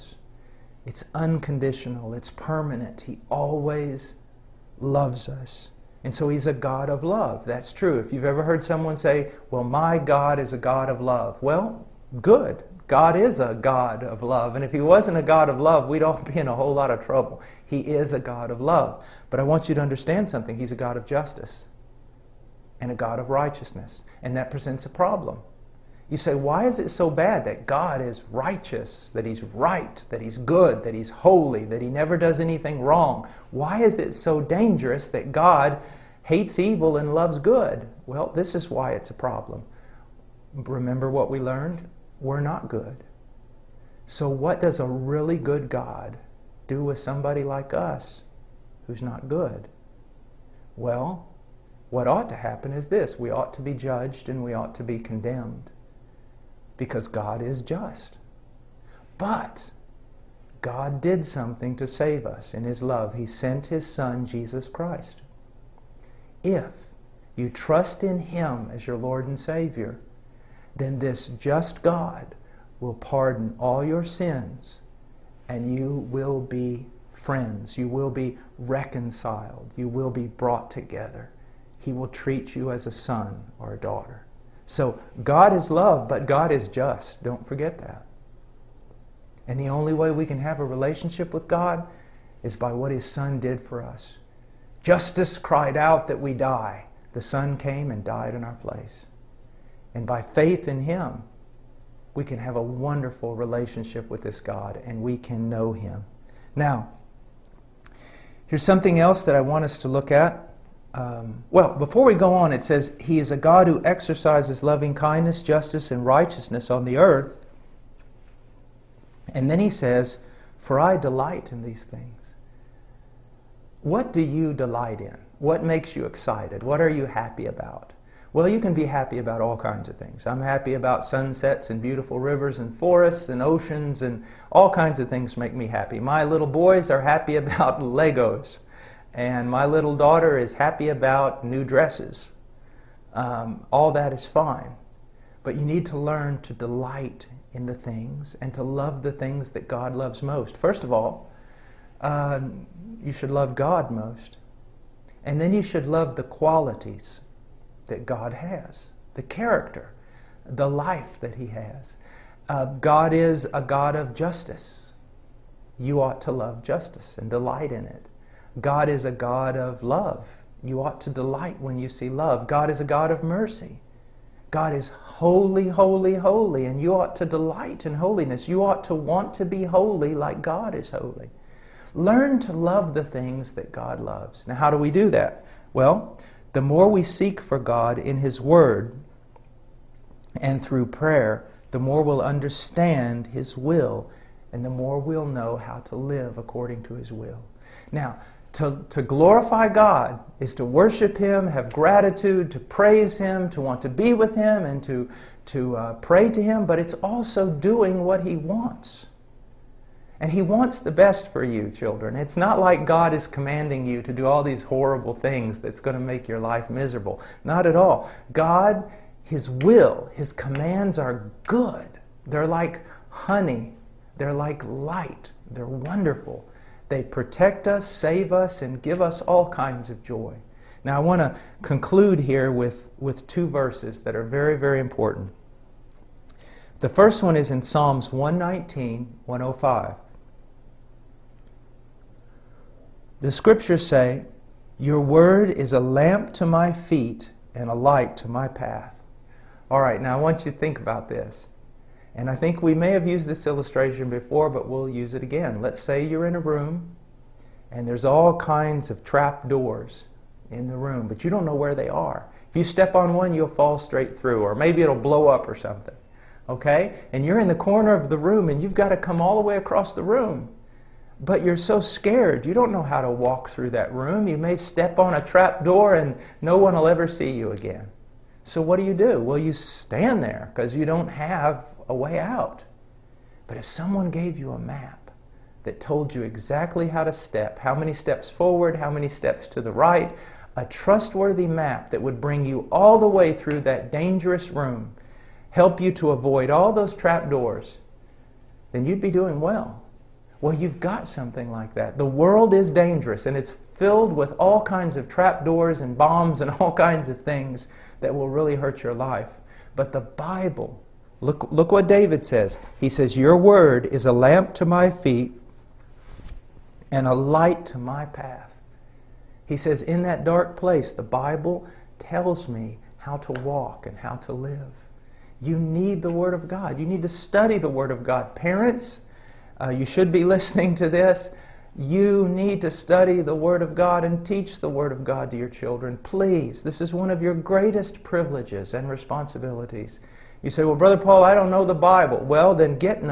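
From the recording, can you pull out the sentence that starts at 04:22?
If you step on one, you'll fall straight through, or maybe it'll blow up or something.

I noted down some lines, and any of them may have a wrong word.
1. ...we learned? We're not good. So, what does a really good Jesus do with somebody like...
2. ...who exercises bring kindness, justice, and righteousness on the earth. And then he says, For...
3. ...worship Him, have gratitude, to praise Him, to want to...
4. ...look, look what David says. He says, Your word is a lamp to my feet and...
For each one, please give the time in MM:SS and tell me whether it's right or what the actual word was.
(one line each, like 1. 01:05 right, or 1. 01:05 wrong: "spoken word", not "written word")
1. 00:41 wrong: "God", not "Jesus"
2. 01:53 wrong: "loving", not "bring"
3. 03:20 right
4. 05:11 right.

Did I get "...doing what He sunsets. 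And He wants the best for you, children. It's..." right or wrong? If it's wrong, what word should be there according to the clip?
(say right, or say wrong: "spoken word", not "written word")
wrong: "wants", not "sunsets".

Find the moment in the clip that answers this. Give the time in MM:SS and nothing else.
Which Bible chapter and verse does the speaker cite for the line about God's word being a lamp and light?
03:57.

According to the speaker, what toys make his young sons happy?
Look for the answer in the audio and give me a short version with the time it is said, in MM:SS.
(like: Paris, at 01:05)
Legos, at 02:17.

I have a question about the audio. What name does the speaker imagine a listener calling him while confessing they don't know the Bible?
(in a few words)
Brother Paul.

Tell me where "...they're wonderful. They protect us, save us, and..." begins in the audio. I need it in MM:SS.
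03:45.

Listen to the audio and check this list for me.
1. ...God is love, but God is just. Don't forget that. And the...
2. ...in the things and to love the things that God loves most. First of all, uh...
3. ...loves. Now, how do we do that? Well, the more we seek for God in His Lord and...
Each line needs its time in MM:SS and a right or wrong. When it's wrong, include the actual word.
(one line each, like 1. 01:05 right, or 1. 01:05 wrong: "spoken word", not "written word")
1. 01:25 right
2. 02:27 right
3. 03:03 wrong: "Word", not "Lord".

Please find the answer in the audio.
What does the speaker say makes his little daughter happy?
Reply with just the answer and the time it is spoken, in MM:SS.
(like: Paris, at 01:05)
New dresses, at 02:21.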